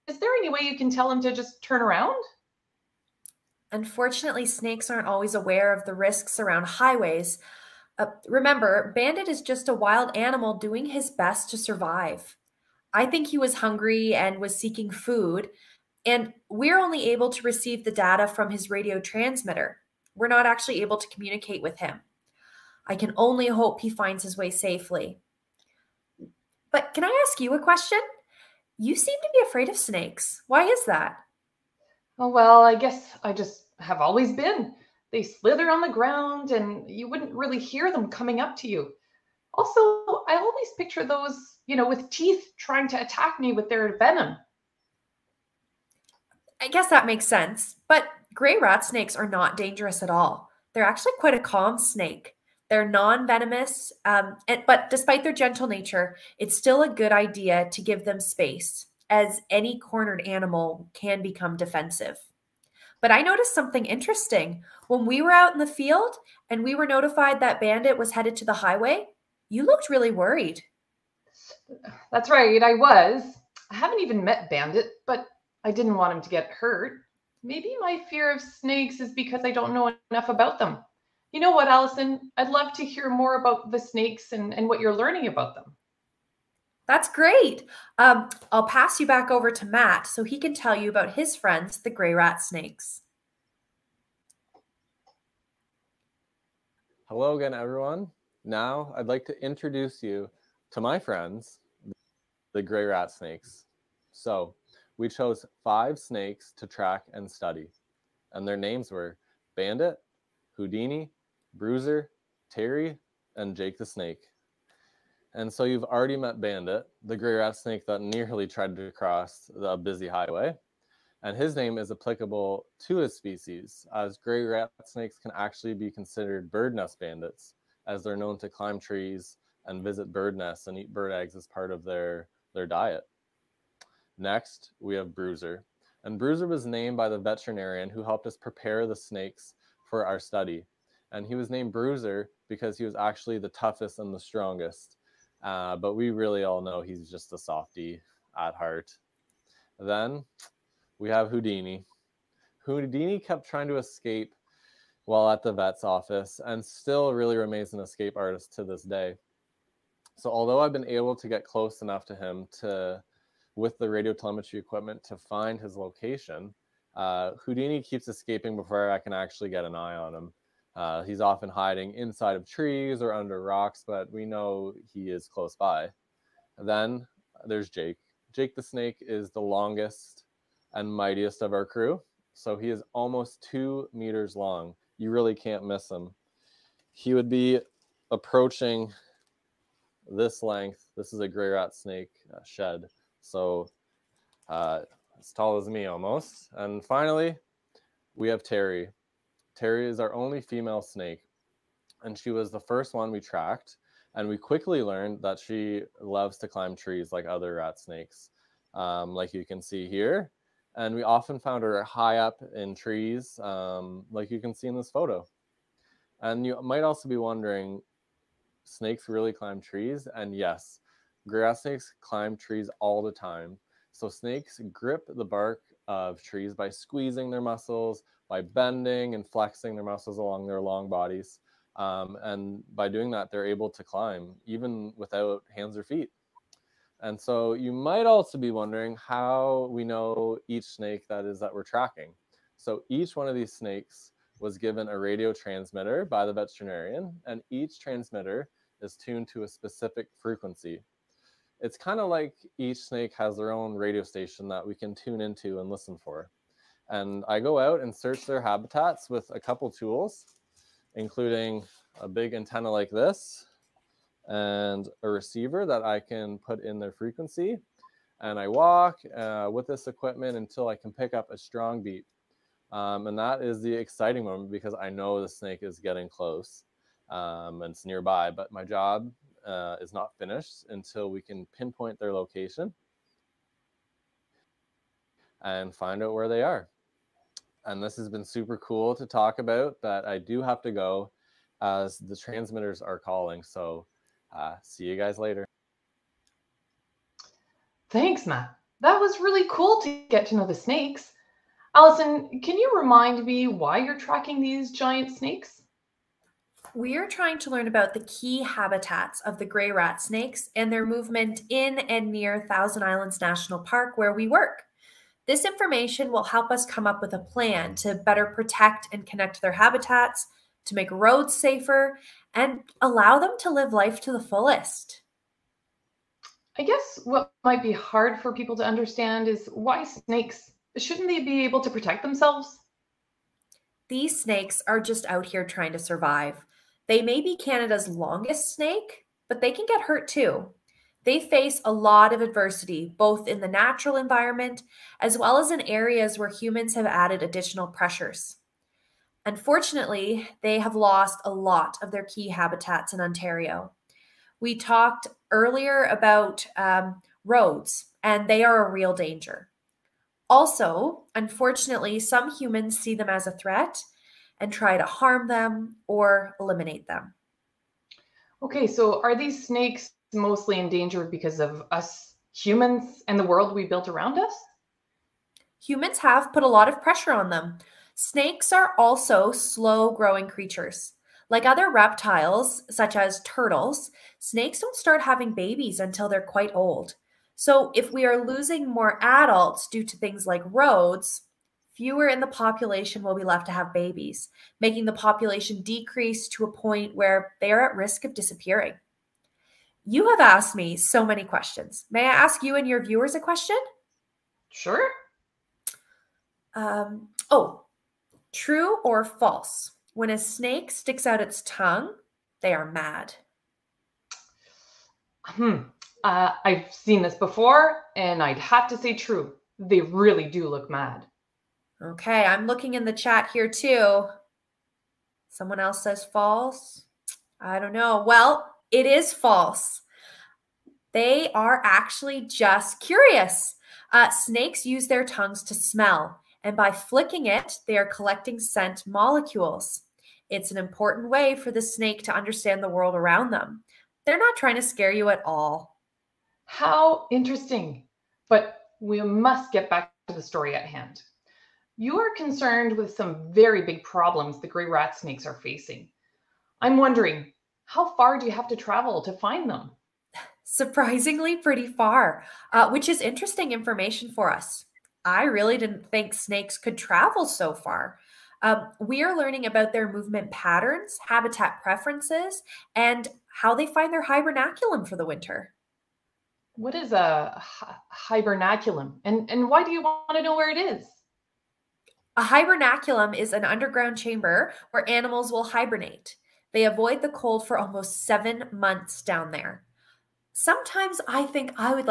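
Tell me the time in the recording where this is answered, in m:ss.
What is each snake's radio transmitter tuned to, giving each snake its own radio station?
4:09.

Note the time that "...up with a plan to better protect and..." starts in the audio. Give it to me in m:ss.
5:16.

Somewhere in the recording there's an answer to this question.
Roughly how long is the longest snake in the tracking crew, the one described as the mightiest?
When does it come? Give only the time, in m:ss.
3:02.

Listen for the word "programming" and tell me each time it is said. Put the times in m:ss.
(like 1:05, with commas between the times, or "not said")
not said.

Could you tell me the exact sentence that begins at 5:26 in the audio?
I guess what might be hard for people to understand is why snakes shouldn't they be able to protect themselves?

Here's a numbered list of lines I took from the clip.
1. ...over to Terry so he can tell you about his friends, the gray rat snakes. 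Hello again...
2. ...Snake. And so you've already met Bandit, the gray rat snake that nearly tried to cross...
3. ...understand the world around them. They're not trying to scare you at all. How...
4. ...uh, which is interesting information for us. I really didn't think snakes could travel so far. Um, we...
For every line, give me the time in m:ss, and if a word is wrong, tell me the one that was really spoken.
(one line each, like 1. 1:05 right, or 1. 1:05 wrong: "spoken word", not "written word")
1. 1:29 wrong: "Matt", not "Terry"
2. 1:53 right
3. 7:22 right
4. 7:42 right.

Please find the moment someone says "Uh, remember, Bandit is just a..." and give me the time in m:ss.
0:07.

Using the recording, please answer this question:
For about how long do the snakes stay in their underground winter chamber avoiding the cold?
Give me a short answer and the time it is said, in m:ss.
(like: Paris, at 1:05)
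almost 7 months, at 8:07.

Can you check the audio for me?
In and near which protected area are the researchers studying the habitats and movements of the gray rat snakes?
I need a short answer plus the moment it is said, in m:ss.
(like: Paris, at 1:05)
Thousand Islands National Park, at 5:12.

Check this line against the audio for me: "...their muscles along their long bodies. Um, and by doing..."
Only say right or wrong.
right.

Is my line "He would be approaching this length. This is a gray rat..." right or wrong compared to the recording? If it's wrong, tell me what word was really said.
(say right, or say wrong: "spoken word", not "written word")
right.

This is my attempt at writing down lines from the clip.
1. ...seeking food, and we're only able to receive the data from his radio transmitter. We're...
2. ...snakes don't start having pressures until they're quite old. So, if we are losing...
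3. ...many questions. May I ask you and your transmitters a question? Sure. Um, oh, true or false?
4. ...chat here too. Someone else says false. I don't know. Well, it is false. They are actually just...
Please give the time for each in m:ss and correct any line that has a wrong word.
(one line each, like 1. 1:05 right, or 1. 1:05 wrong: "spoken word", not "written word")
1. 0:14 right
2. 6:24 wrong: "babies", not "pressures"
3. 6:41 wrong: "viewers", not "transmitters"
4. 7:02 right.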